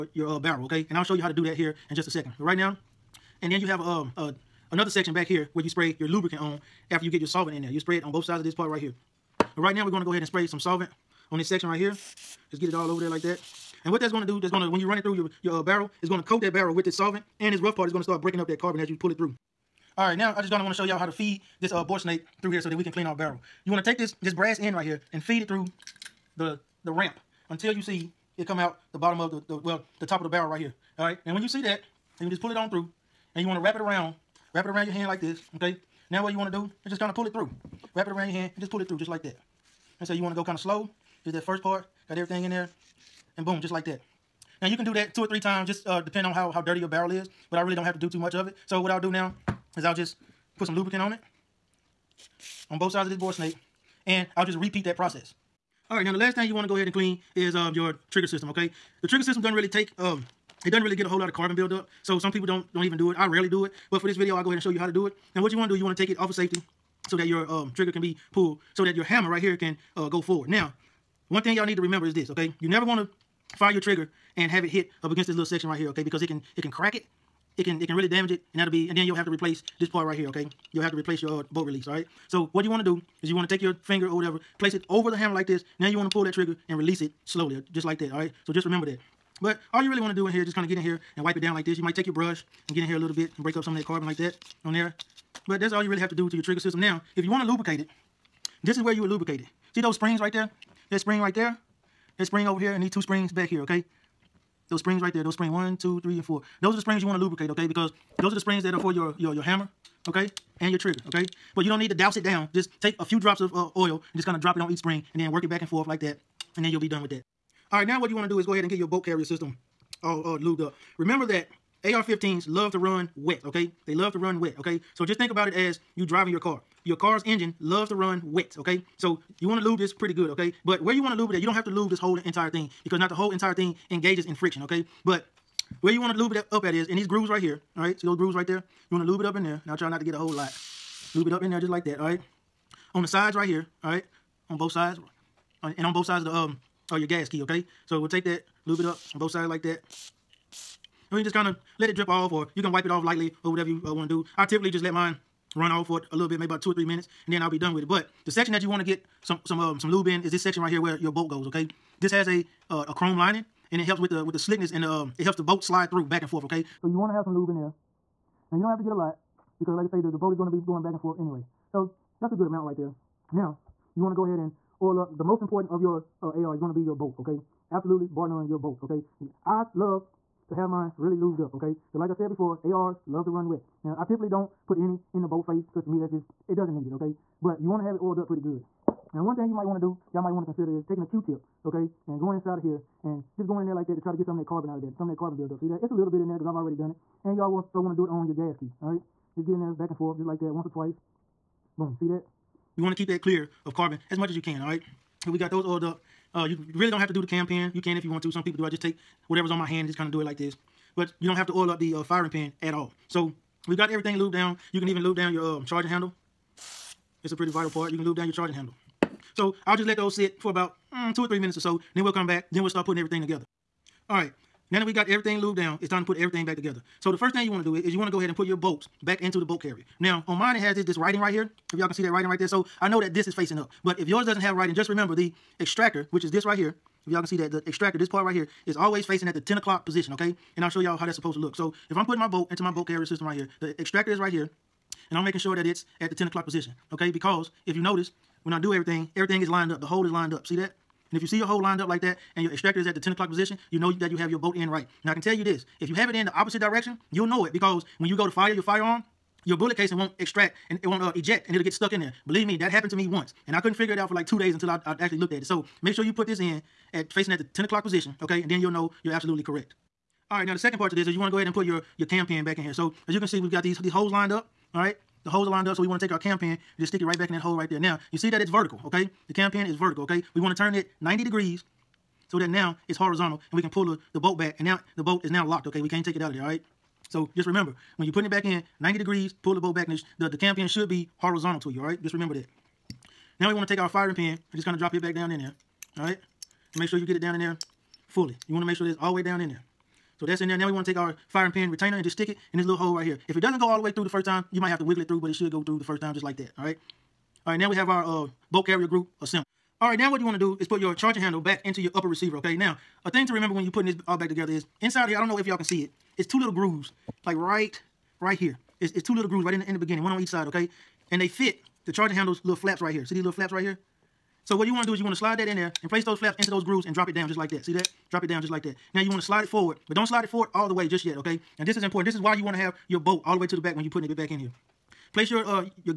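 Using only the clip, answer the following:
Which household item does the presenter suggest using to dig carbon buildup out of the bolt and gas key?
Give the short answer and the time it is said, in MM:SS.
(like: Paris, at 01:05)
Q-tip, at 03:11.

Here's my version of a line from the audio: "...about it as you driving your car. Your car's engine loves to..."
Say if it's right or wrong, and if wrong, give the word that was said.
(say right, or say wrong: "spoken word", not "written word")
right.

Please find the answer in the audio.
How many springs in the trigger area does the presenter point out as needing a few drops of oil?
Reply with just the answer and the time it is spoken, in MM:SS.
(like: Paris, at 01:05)
4, at 01:46.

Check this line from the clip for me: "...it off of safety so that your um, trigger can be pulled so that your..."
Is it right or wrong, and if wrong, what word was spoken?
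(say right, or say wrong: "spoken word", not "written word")
right.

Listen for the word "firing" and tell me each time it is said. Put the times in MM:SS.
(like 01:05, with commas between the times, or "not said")
03:32, 04:53, 05:01.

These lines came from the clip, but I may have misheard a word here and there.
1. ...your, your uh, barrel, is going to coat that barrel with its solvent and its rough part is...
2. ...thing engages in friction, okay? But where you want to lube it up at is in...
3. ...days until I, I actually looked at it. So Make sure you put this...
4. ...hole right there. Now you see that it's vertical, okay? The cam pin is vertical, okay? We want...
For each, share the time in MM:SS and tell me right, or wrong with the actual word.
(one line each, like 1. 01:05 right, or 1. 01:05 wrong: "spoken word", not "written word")
1. 00:15 right
2. 02:13 right
3. 04:24 right
4. 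04:37 right.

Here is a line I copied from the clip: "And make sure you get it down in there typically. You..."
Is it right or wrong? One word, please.
wrong.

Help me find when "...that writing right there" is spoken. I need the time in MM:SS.
03:52.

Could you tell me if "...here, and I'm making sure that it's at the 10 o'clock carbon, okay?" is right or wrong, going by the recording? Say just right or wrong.
wrong.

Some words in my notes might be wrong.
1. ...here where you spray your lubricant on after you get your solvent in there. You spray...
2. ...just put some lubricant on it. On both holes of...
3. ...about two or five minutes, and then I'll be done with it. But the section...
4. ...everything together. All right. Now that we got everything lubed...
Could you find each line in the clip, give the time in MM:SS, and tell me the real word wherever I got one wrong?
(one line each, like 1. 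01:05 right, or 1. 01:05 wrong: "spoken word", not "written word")
1. 00:05 right
2. 00:49 wrong: "sides", not "holes"
3. 02:36 wrong: "three", not "five"
4. 03:42 right.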